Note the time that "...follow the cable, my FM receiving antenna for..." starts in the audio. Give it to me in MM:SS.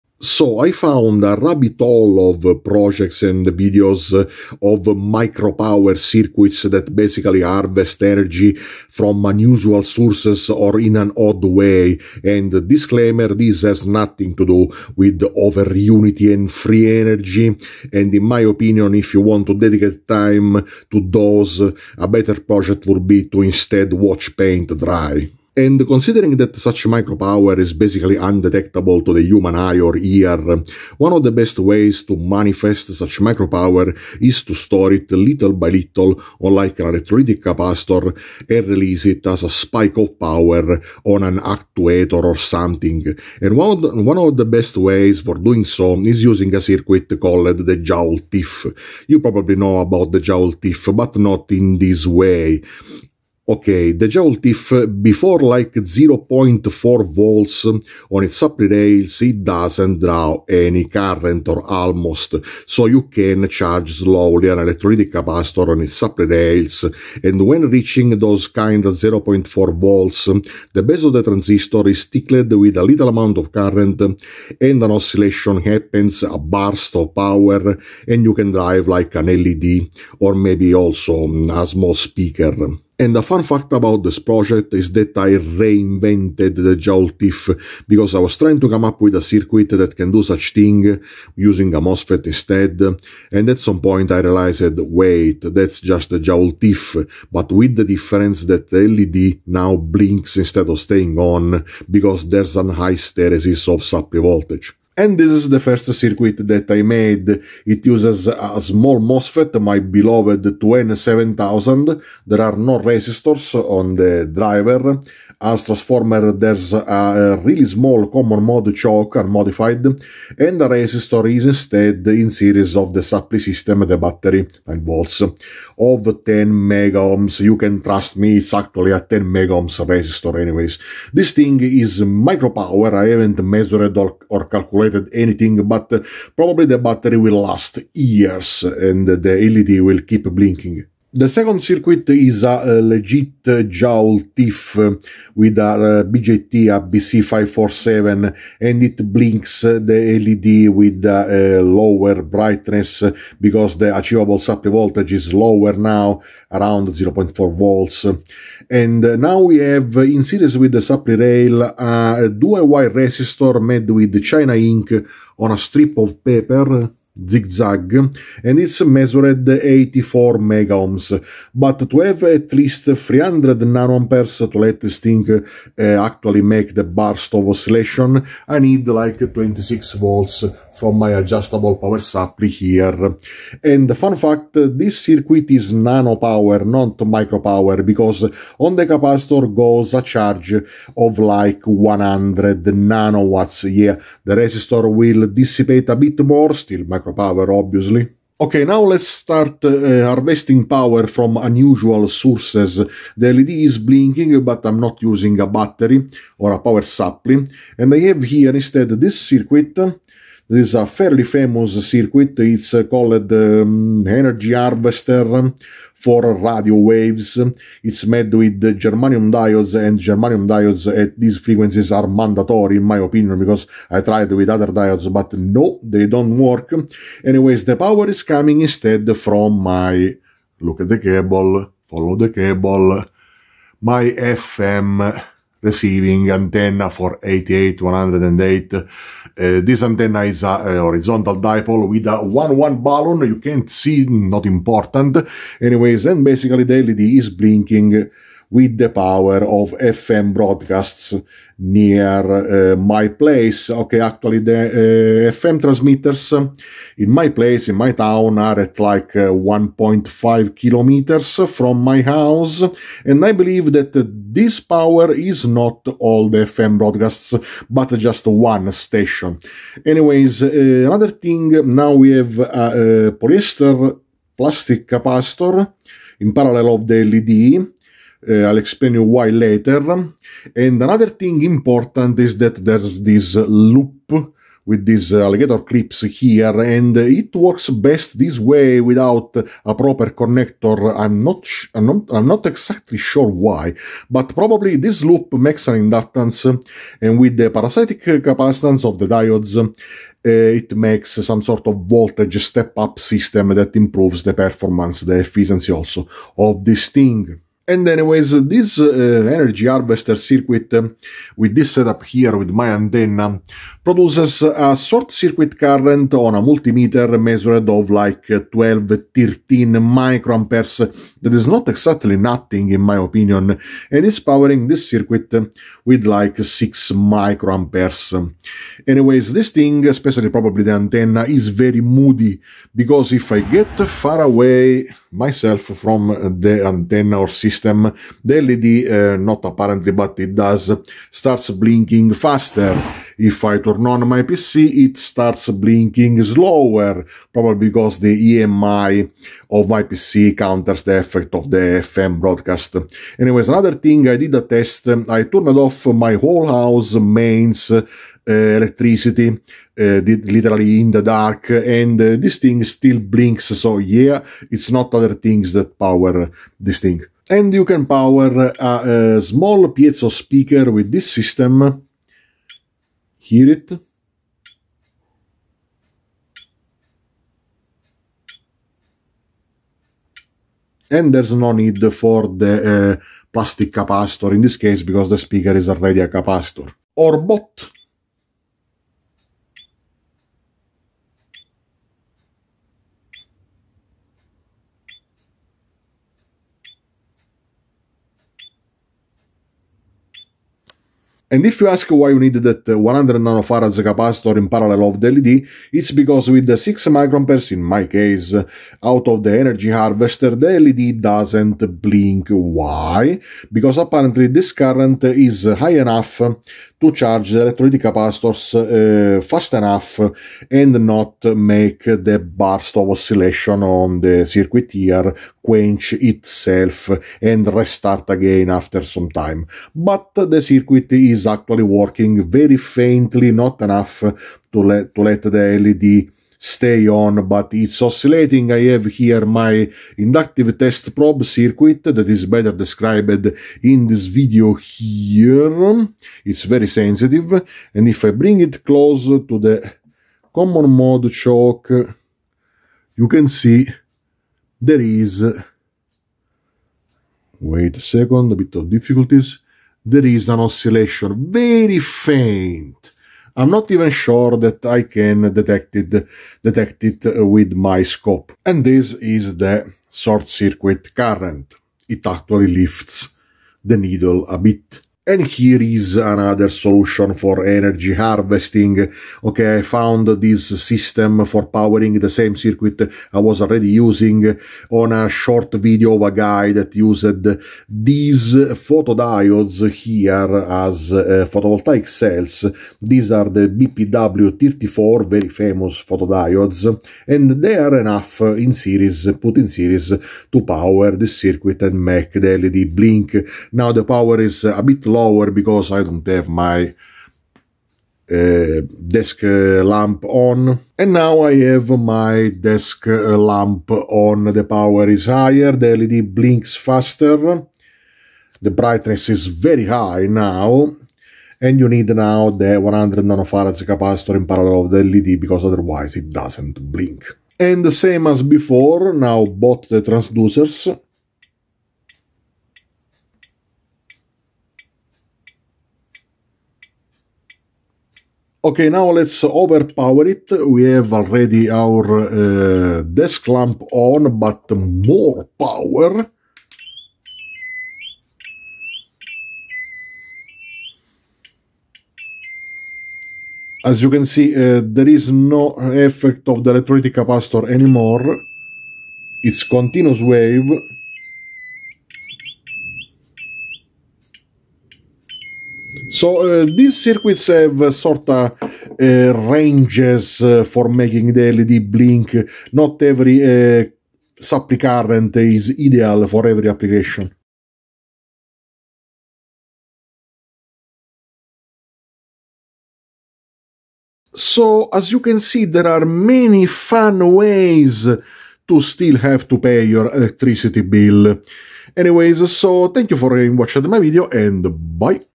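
03:51.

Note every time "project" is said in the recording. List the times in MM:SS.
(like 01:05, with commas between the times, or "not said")
00:02, 00:22, 01:24.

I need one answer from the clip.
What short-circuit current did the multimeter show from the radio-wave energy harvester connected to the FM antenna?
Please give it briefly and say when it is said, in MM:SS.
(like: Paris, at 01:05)
12-13 microamperes, at 05:18.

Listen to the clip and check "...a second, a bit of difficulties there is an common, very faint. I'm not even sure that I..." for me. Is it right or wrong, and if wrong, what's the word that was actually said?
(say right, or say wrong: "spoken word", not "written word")
wrong: "oscillation", not "common".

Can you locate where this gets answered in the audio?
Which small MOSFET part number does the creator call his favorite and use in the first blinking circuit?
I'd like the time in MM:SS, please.
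01:50.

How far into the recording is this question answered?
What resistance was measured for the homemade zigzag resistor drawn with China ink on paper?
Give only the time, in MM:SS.
02:49.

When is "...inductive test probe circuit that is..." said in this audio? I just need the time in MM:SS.
07:19.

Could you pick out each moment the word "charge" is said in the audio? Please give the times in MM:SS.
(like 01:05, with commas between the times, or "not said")
01:03, 03:10, 06:56.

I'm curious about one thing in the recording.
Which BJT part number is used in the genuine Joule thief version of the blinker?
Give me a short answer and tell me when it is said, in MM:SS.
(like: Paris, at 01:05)
BC547, at 02:26.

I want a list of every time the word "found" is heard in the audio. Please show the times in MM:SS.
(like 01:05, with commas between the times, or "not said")
00:00, 07:59.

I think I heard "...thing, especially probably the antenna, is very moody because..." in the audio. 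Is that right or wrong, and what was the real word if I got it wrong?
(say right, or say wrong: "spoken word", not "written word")
right.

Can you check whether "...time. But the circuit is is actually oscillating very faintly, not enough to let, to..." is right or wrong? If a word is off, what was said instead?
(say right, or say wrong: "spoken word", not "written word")
wrong: "working", not "oscillating".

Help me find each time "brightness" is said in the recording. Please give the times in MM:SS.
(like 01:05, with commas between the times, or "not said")
02:32, 08:38.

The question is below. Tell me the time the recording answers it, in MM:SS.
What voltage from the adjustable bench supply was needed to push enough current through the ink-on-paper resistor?
02:59.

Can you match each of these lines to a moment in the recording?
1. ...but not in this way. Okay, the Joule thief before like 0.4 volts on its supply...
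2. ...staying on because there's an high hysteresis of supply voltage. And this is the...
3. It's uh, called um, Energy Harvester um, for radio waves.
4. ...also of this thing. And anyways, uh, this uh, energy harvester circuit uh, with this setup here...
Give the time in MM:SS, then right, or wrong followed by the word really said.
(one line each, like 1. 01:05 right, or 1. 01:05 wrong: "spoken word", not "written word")
1. 00:50 right
2. 01:40 right
3. 03:32 right
4. 05:05 right.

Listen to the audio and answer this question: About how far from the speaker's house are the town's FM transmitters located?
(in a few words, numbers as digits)
1.5 kilometers.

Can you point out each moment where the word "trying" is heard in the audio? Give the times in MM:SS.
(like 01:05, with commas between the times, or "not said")
01:28.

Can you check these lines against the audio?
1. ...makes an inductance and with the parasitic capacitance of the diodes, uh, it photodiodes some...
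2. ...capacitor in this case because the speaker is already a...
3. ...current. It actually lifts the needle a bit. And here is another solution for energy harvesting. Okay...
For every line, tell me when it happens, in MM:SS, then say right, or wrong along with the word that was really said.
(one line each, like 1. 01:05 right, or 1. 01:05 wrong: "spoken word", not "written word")
1. 04:55 wrong: "makes", not "photodiodes"
2. 06:23 right
3. 07:50 right.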